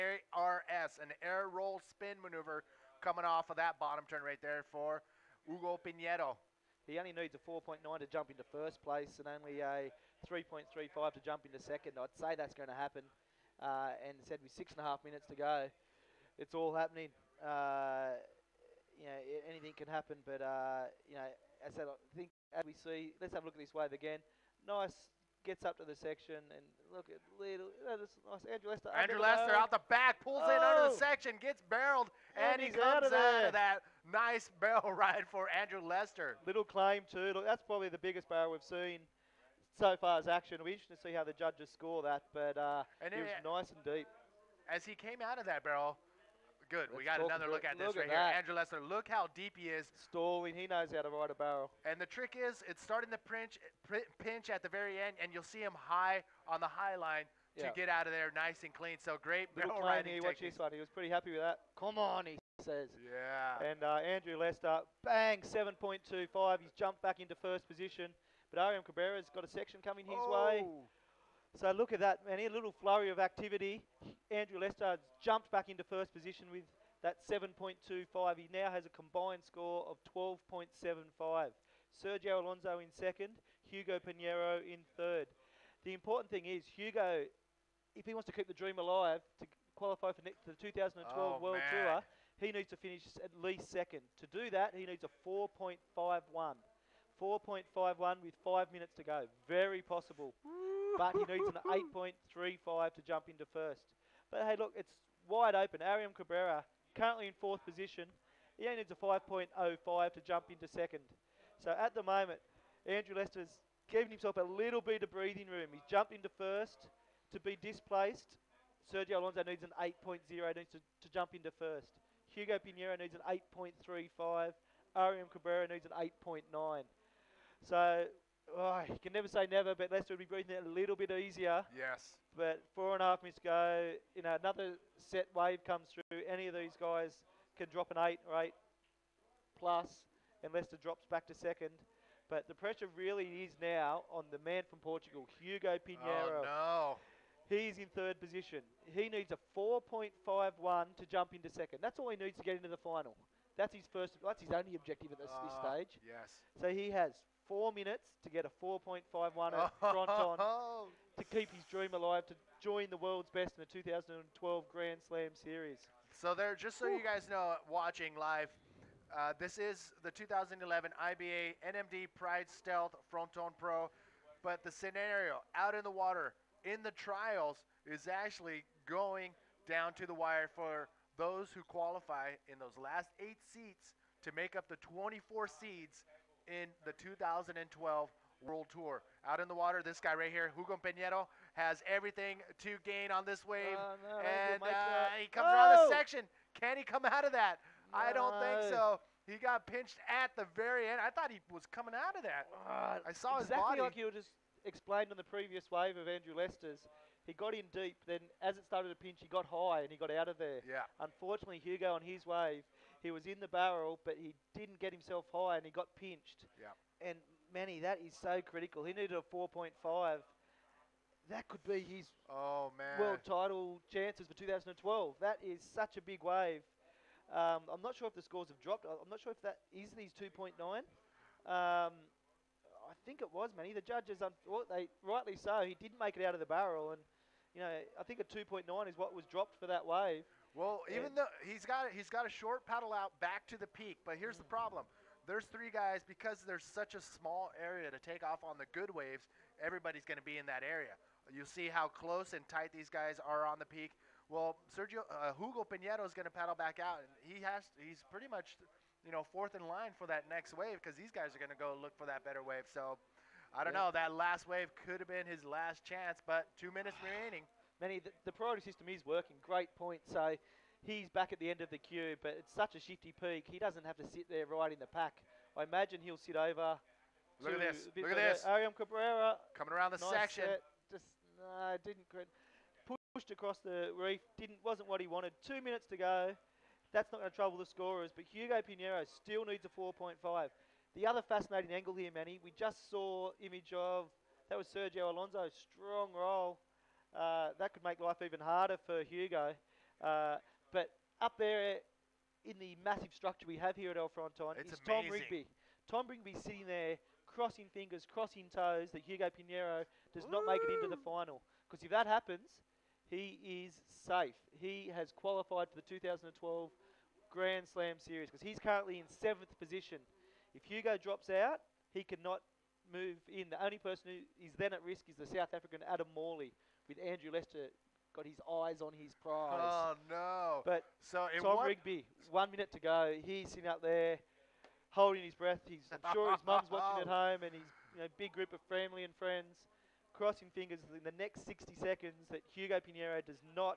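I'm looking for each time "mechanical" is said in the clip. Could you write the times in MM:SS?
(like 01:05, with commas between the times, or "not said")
not said.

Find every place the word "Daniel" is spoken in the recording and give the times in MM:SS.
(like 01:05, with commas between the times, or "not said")
not said.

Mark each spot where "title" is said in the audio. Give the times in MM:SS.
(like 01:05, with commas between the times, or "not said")
03:43.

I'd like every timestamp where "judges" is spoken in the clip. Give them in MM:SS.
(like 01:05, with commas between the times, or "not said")
00:41, 03:53.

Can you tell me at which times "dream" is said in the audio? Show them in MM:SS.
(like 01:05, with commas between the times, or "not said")
01:28, 02:41.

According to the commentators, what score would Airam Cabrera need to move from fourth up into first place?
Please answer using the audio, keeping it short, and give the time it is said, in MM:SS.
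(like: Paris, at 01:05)
8.9, at 02:06.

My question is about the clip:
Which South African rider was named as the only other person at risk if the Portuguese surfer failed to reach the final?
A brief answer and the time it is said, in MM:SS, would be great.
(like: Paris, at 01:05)
Adam Morley, at 05:25.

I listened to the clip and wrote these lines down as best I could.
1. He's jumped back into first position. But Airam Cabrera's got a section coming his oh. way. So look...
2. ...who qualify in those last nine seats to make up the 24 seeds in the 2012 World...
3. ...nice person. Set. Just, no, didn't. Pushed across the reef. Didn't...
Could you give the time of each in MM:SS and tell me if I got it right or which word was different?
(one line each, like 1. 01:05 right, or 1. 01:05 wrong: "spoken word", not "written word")
1. 01:06 right
2. 03:01 wrong: "eight", not "nine"
3. 04:39 wrong: "section", not "person".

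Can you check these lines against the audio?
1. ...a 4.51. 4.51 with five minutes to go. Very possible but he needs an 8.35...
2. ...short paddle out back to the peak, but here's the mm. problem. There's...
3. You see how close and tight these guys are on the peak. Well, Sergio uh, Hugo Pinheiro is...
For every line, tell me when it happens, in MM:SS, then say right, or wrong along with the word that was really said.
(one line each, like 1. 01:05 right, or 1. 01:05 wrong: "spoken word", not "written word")
1. 01:35 right
2. 04:02 right
3. 04:11 right.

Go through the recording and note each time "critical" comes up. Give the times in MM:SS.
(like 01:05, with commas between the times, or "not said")
03:38.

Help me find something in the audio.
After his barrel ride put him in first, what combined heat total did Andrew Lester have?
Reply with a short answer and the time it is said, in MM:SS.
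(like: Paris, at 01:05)
12.75, at 01:20.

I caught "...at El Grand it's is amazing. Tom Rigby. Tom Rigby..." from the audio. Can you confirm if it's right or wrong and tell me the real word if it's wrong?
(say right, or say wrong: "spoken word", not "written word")
wrong: "Fronton", not "Grand".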